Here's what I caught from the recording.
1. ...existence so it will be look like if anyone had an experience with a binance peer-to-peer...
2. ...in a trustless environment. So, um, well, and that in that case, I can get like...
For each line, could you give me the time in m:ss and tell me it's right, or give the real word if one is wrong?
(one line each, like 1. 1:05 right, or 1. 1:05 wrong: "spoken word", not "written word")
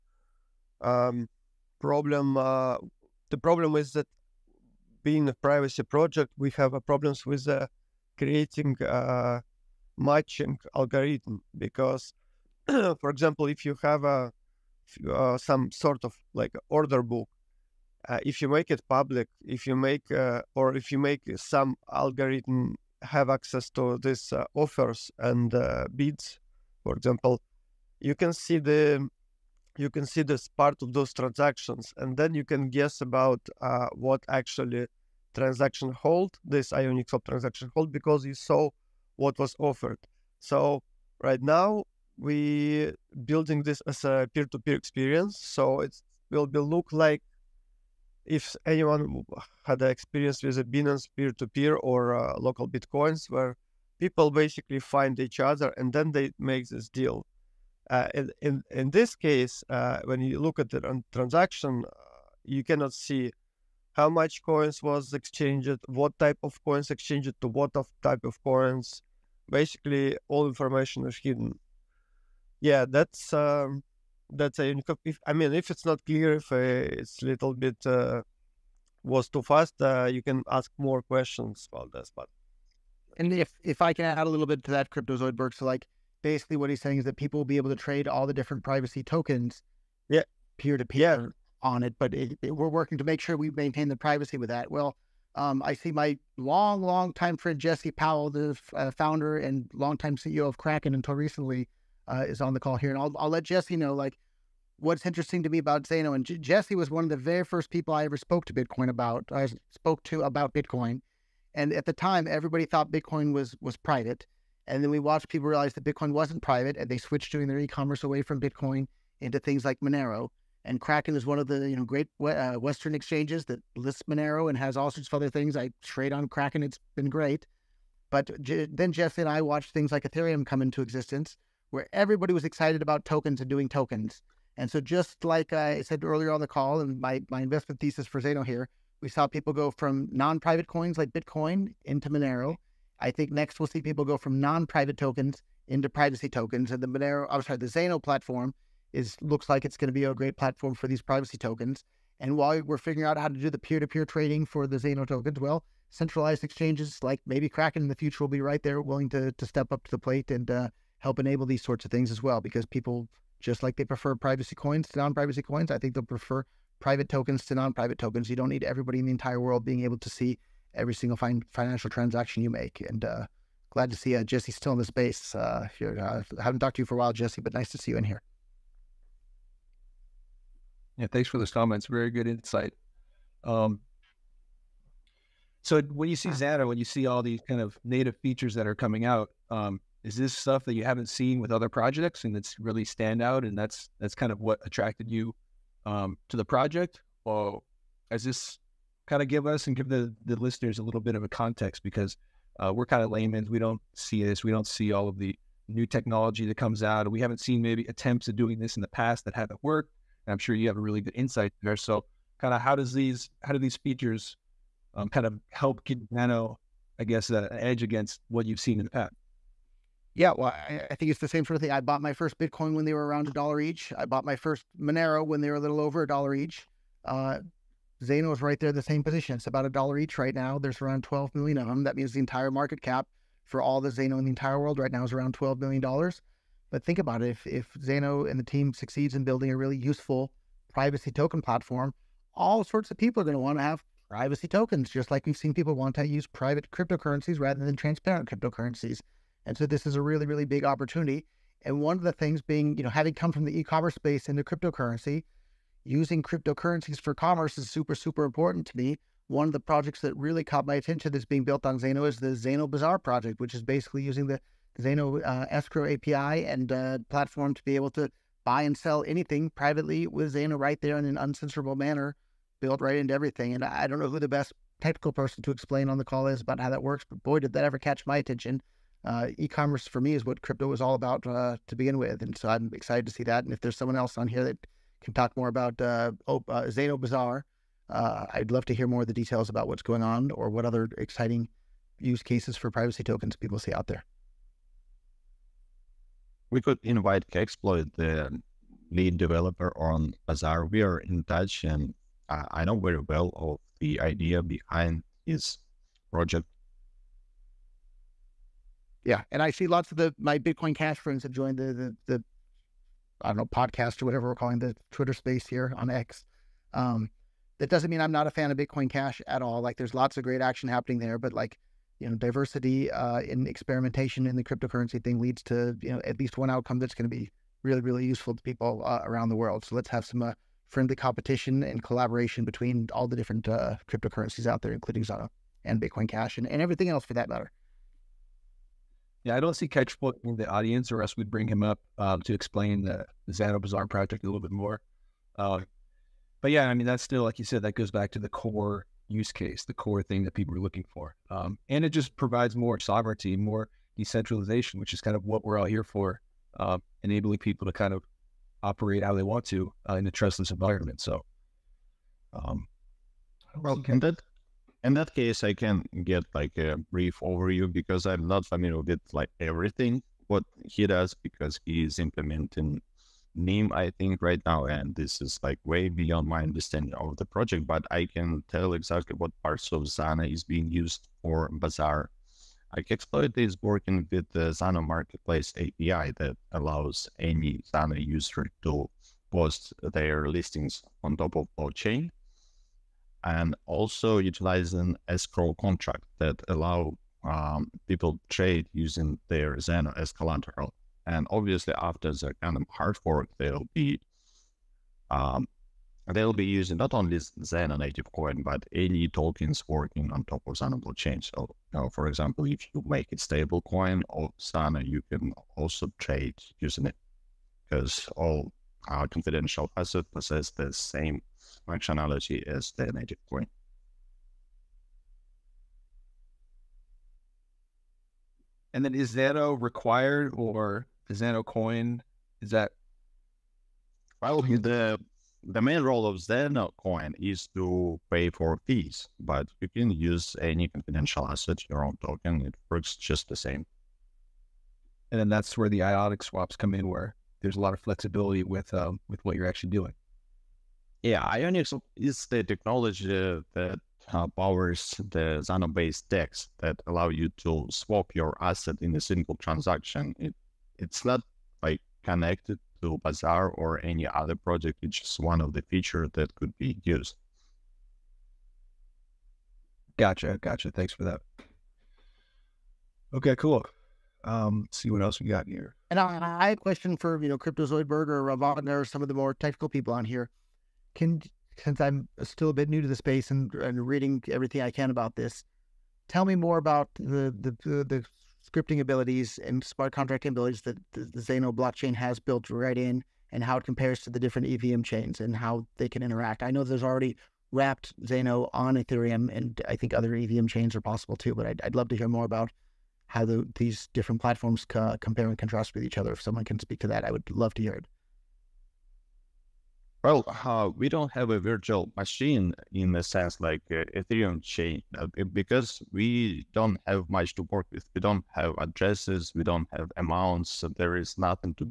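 1. 0:44 wrong: "experience", not "existence"
2. 5:59 right.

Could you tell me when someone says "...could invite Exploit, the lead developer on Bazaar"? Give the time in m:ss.
4:56.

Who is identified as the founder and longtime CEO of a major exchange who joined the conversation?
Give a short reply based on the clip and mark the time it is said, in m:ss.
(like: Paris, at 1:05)
Jesse Powell, at 1:37.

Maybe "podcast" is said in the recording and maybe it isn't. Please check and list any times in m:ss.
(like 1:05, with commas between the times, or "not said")
5:13.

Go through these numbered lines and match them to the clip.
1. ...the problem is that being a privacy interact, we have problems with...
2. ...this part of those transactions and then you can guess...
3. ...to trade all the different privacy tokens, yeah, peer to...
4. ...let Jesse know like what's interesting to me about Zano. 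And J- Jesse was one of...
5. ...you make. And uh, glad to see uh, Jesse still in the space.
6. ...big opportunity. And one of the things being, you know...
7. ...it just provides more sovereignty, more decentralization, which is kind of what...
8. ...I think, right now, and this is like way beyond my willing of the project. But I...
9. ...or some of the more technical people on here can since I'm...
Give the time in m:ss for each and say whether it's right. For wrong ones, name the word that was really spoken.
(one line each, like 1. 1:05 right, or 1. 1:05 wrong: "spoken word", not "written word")
1. 0:03 wrong: "project", not "interact"
2. 0:30 right
3. 1:27 right
4. 1:43 right
5. 2:52 right
6. 4:10 right
7. 5:51 right
8. 6:13 wrong: "understanding", not "willing"
9. 7:58 right.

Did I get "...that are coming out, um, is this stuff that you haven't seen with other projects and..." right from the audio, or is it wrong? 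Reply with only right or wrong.
right.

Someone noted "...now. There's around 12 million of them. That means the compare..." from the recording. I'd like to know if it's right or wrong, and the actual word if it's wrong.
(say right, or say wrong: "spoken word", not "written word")
wrong: "entire", not "compare".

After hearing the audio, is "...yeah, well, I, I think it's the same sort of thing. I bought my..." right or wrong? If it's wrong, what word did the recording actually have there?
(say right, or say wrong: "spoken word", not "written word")
right.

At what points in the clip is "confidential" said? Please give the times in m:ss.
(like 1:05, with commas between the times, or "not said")
6:59, 7:20.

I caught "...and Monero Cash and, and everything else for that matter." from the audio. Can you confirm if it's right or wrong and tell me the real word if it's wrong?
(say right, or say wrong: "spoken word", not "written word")
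wrong: "Bitcoin", not "Monero".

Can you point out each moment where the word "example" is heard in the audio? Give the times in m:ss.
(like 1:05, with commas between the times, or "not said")
0:13, 0:26, 6:52.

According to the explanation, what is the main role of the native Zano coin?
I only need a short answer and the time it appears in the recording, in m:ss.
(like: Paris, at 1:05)
To pay for fees, at 7:18.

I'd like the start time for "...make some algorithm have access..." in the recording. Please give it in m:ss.
0:20.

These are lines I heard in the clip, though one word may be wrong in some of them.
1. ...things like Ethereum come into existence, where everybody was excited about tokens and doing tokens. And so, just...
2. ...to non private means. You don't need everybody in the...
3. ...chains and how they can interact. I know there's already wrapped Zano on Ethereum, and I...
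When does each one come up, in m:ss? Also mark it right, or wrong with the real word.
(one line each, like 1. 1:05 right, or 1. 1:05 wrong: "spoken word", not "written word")
1. 2:09 right
2. 2:47 wrong: "tokens", not "means"
3. 8:14 right.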